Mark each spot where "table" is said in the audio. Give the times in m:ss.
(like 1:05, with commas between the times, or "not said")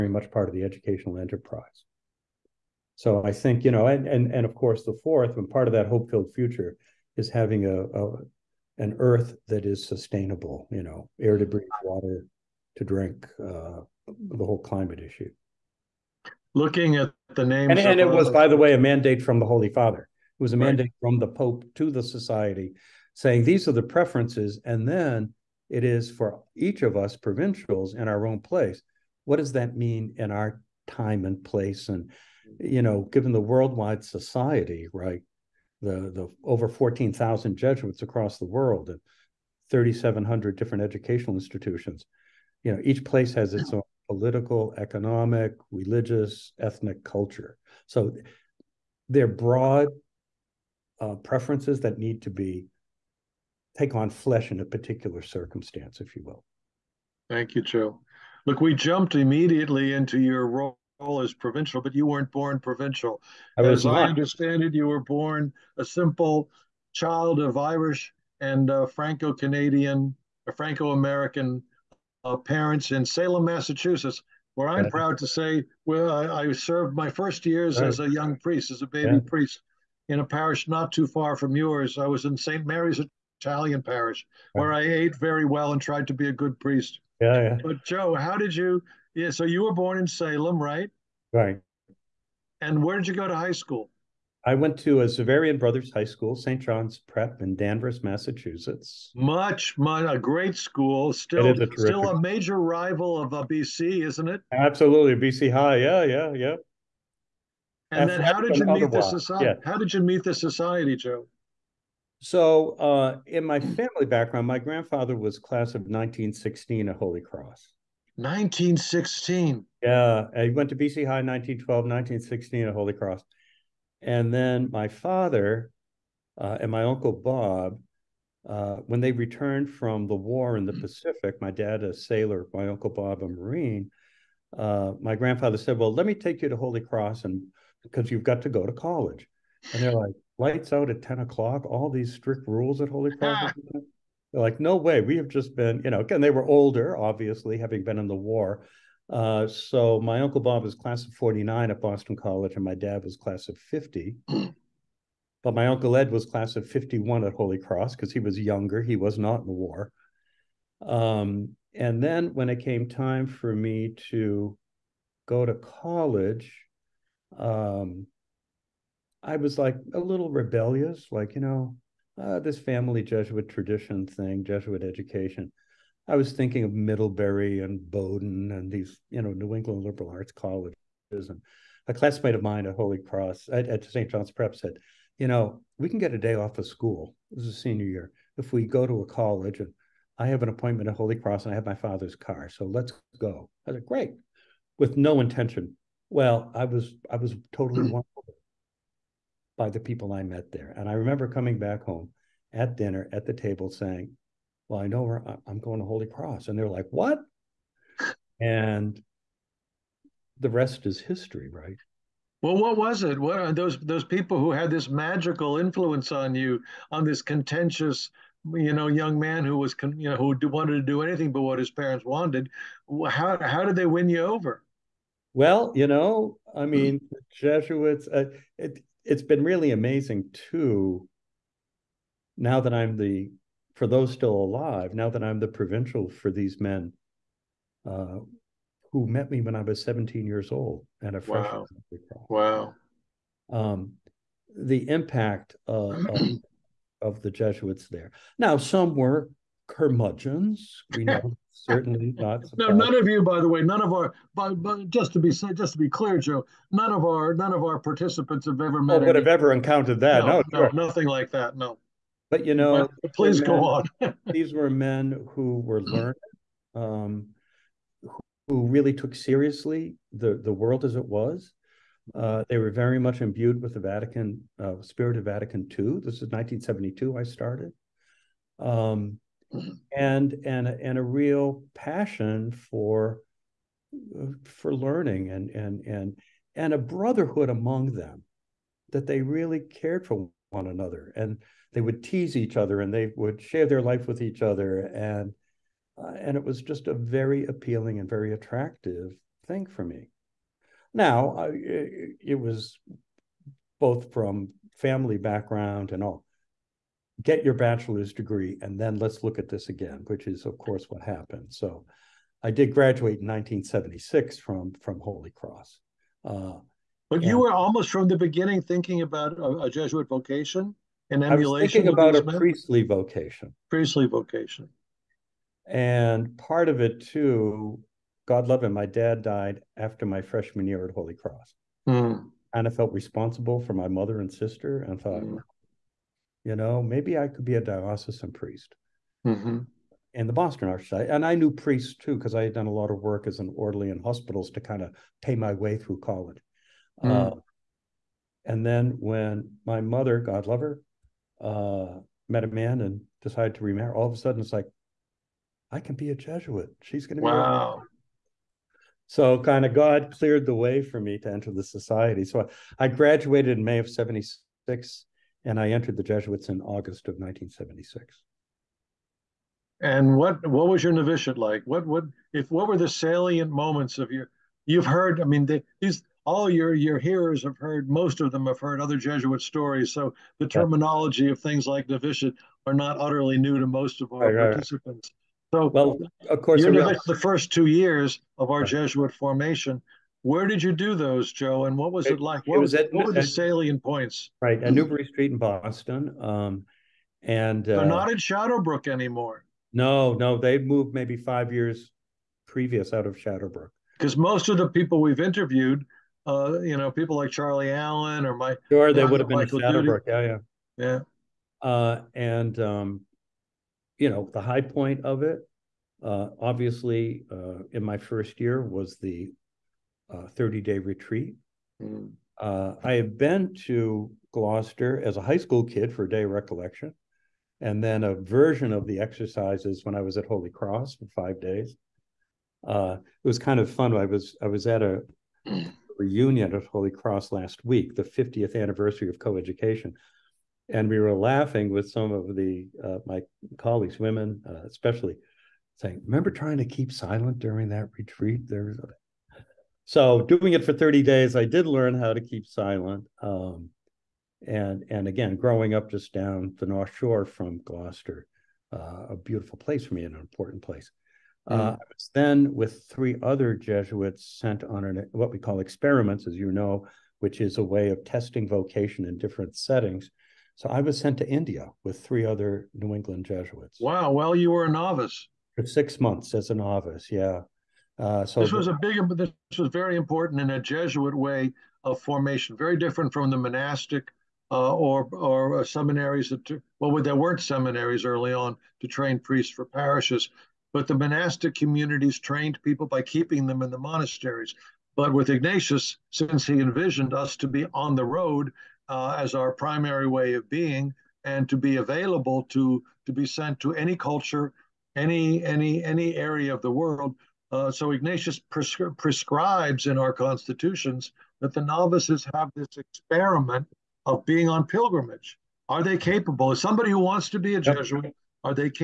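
3:23.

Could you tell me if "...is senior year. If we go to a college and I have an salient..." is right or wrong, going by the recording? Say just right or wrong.
wrong.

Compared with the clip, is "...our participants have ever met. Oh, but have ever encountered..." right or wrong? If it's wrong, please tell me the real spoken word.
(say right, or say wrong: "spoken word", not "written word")
right.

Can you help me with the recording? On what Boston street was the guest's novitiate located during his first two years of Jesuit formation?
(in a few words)
Newbury Street.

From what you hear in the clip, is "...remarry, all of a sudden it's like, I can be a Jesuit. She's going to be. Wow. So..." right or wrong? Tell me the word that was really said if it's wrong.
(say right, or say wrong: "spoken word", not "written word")
right.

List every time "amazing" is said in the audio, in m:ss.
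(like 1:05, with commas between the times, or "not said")
3:49.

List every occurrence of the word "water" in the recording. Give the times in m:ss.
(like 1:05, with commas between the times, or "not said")
0:11.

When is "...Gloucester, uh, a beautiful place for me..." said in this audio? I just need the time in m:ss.
7:37.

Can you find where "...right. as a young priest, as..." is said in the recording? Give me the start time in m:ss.
1:17.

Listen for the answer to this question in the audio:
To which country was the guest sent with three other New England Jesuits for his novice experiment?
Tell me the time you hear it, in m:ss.
7:51.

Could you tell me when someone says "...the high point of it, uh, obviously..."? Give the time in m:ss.
6:54.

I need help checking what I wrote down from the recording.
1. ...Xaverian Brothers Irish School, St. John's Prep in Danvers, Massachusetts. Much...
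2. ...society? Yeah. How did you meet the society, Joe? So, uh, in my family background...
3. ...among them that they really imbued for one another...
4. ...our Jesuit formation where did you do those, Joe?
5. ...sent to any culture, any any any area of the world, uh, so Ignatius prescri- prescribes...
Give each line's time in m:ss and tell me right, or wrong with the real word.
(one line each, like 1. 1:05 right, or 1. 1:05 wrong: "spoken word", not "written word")
1. 1:35 wrong: "High", not "Irish"
2. 1:49 right
3. 4:47 wrong: "cared", not "imbued"
4. 6:28 right
5. 8:23 right.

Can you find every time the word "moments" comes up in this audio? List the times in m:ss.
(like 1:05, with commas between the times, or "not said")
6:13.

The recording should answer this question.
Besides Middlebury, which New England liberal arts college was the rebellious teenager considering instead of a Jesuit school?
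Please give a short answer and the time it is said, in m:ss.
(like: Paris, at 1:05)
Bowdoin, at 2:57.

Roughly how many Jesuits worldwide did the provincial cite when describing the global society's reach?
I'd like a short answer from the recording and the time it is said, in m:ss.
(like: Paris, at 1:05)
14,000, at 0:36.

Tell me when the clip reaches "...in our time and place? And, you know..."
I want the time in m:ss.
0:30.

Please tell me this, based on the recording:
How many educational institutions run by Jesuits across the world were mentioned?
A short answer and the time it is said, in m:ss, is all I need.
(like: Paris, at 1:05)
3,700, at 0:39.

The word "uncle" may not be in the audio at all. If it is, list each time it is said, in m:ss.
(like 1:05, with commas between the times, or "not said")
2:06, 2:12, 2:30, 2:35.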